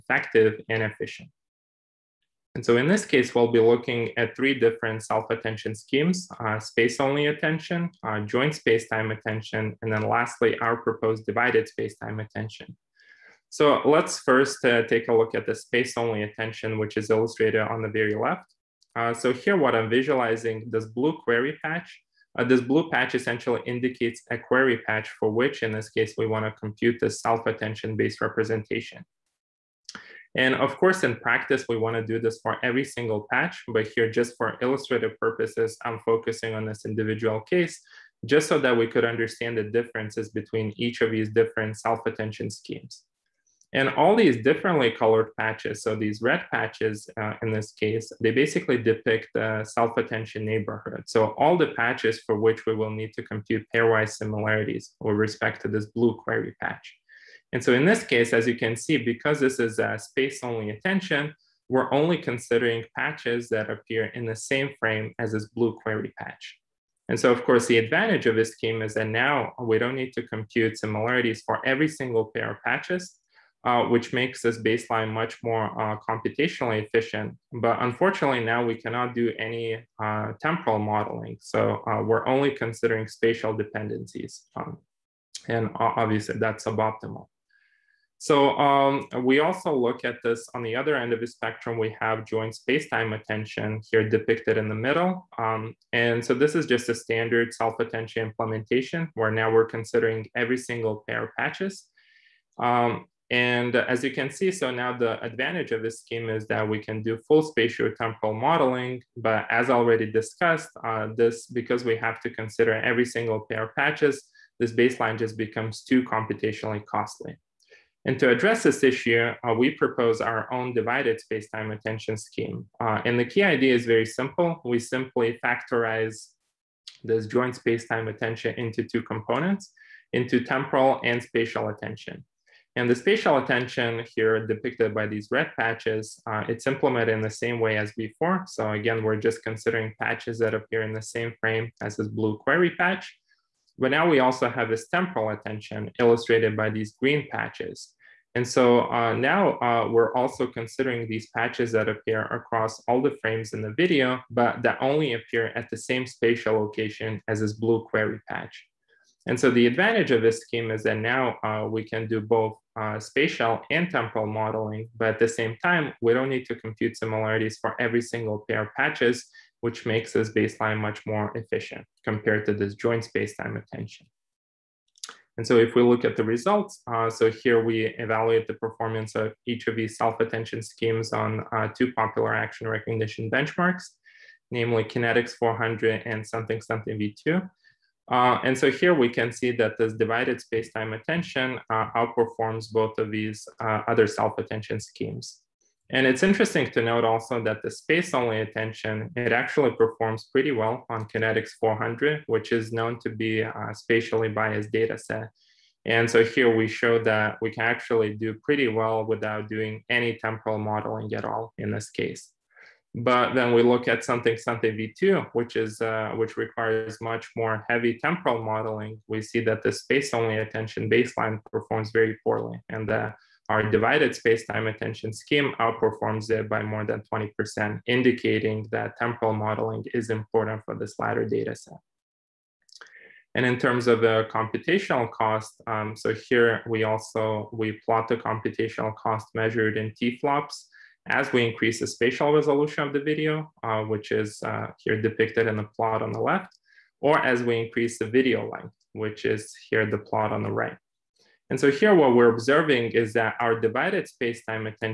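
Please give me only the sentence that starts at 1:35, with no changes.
Um, and so this is just a standard self-attention implementation where now we're considering every single pair of patches.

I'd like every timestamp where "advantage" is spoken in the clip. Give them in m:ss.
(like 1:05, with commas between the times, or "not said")
1:07, 1:45, 2:39.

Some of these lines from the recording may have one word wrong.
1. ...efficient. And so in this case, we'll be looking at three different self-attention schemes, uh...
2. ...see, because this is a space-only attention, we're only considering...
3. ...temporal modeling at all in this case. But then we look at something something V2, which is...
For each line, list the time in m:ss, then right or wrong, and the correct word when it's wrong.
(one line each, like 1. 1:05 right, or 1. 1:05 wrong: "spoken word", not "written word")
1. 0:00 right
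2. 0:58 right
3. 3:30 right.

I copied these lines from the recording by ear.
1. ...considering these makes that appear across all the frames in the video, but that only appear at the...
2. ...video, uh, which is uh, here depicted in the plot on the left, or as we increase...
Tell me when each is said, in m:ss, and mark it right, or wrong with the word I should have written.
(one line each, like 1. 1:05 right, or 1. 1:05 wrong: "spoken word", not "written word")
1. 2:30 wrong: "patches", not "makes"
2. 4:03 right.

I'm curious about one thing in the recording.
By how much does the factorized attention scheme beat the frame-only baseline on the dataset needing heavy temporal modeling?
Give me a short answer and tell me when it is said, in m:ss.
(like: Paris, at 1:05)
More than 20%, at 3:46.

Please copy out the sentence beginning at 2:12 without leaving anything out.
And the spatial attention here depicted by these red patches, uh, it's implemented in the same way as before.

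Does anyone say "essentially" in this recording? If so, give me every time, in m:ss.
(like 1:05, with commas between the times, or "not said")
0:23.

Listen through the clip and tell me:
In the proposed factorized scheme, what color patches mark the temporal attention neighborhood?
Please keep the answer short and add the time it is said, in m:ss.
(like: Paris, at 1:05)
Green, at 2:26.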